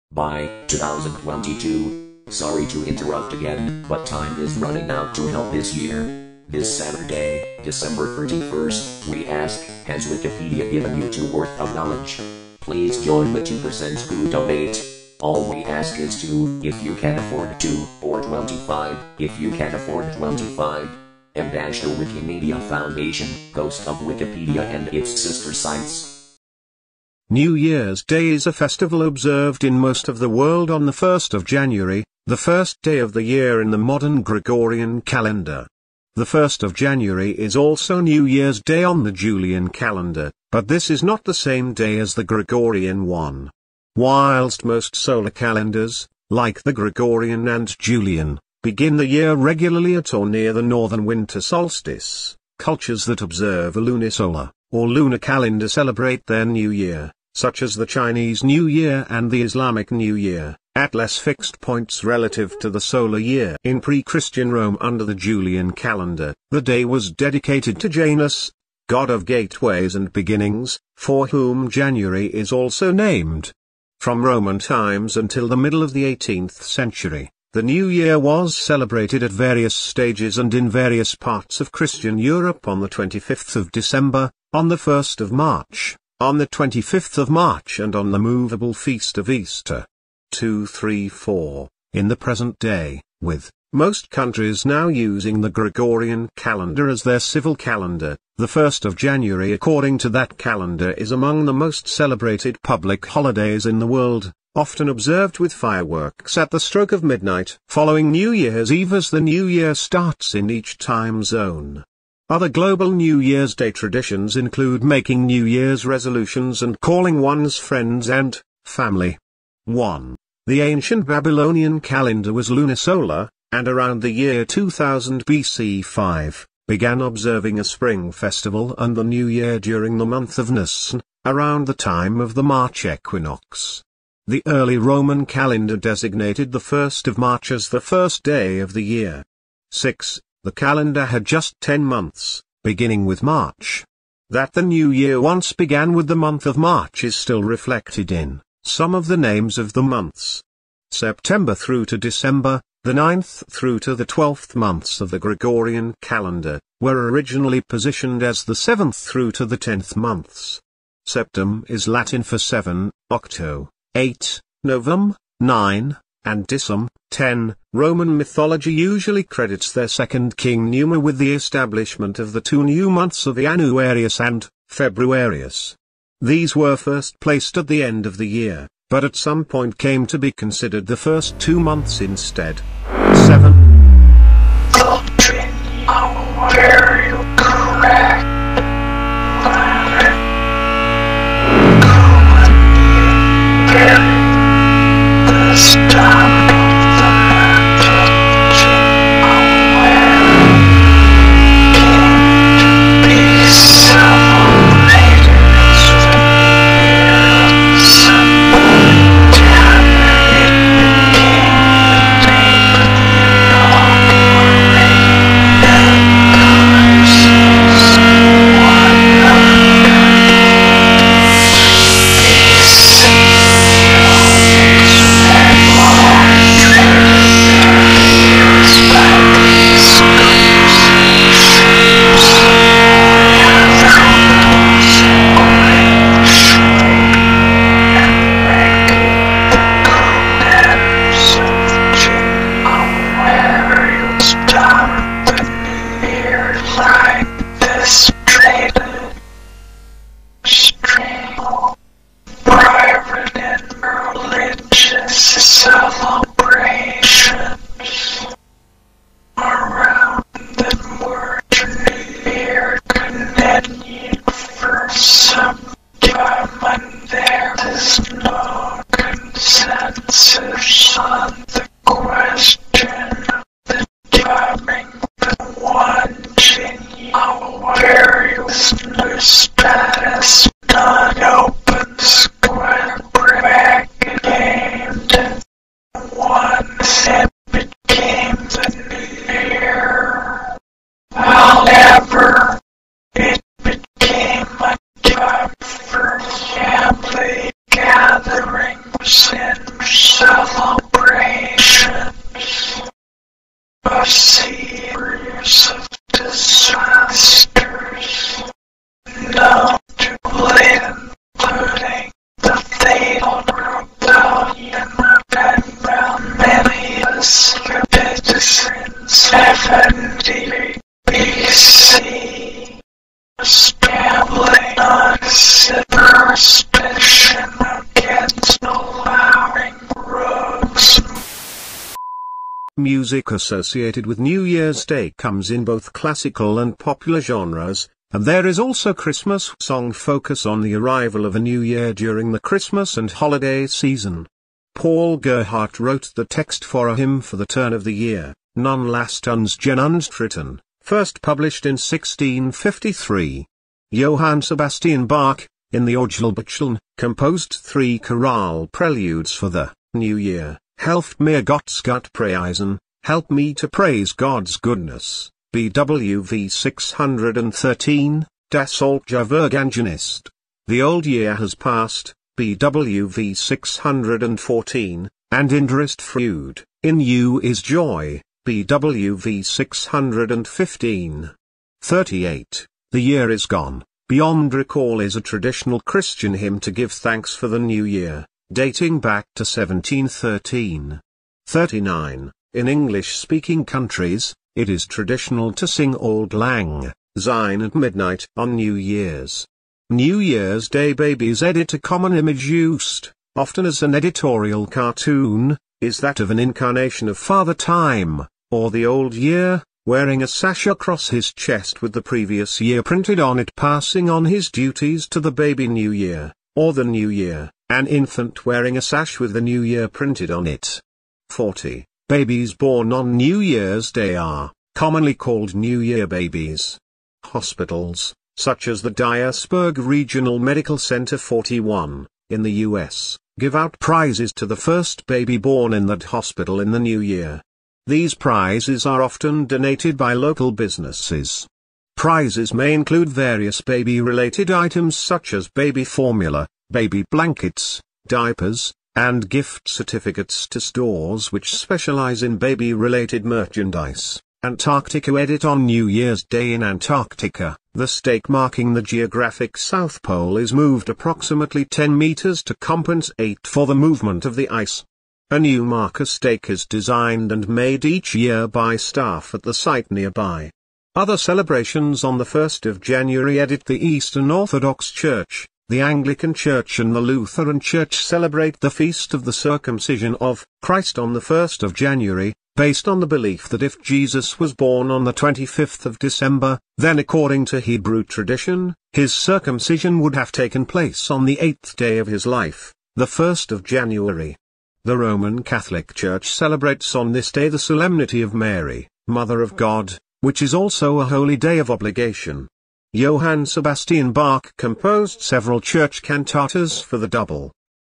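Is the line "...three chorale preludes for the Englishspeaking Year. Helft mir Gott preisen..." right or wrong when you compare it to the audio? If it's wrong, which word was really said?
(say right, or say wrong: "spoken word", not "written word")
wrong: "New", not "Englishspeaking".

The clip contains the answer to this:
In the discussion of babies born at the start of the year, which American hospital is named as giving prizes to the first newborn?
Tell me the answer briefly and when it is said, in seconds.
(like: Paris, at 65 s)
Dyersburg Regional Medical Center, at 428 s.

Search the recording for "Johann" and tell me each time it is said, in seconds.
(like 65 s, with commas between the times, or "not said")
353 s, 502 s.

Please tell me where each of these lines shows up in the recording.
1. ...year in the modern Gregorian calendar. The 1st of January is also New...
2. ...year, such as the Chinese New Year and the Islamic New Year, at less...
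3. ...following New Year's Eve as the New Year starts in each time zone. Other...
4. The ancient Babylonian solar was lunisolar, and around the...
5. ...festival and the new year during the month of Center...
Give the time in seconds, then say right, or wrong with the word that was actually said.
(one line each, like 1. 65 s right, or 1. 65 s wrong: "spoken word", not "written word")
1. 33 s right
2. 56 s right
3. 107 s right
4. 120 s wrong: "calendar", not "solar"
5. 128 s wrong: "Nisan", not "Center".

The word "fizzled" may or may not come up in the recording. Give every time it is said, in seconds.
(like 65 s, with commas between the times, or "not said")
not said.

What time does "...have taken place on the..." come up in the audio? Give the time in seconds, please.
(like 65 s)
490 s.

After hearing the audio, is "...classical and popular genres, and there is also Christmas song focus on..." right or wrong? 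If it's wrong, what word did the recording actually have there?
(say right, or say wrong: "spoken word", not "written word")
right.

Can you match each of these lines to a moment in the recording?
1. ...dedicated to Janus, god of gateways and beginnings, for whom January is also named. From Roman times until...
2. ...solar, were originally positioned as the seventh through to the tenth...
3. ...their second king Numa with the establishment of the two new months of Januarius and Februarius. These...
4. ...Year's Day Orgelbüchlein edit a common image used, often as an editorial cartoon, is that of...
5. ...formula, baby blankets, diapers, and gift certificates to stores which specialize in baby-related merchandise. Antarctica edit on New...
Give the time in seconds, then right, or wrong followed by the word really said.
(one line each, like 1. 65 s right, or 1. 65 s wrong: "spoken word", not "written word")
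1. 67 s right
2. 156 s wrong: "calendar", not "solar"
3. 169 s right
4. 400 s wrong: "Babies", not "Orgelbüchlein"
5. 445 s right.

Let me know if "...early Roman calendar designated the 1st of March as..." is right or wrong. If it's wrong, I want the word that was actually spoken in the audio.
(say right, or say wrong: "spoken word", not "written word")
right.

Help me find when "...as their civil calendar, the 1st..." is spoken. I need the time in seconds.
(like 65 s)
96 s.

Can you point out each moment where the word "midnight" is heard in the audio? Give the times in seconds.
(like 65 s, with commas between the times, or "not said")
107 s, 397 s.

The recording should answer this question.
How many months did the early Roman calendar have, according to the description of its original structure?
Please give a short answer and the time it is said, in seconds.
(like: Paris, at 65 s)
10, at 141 s.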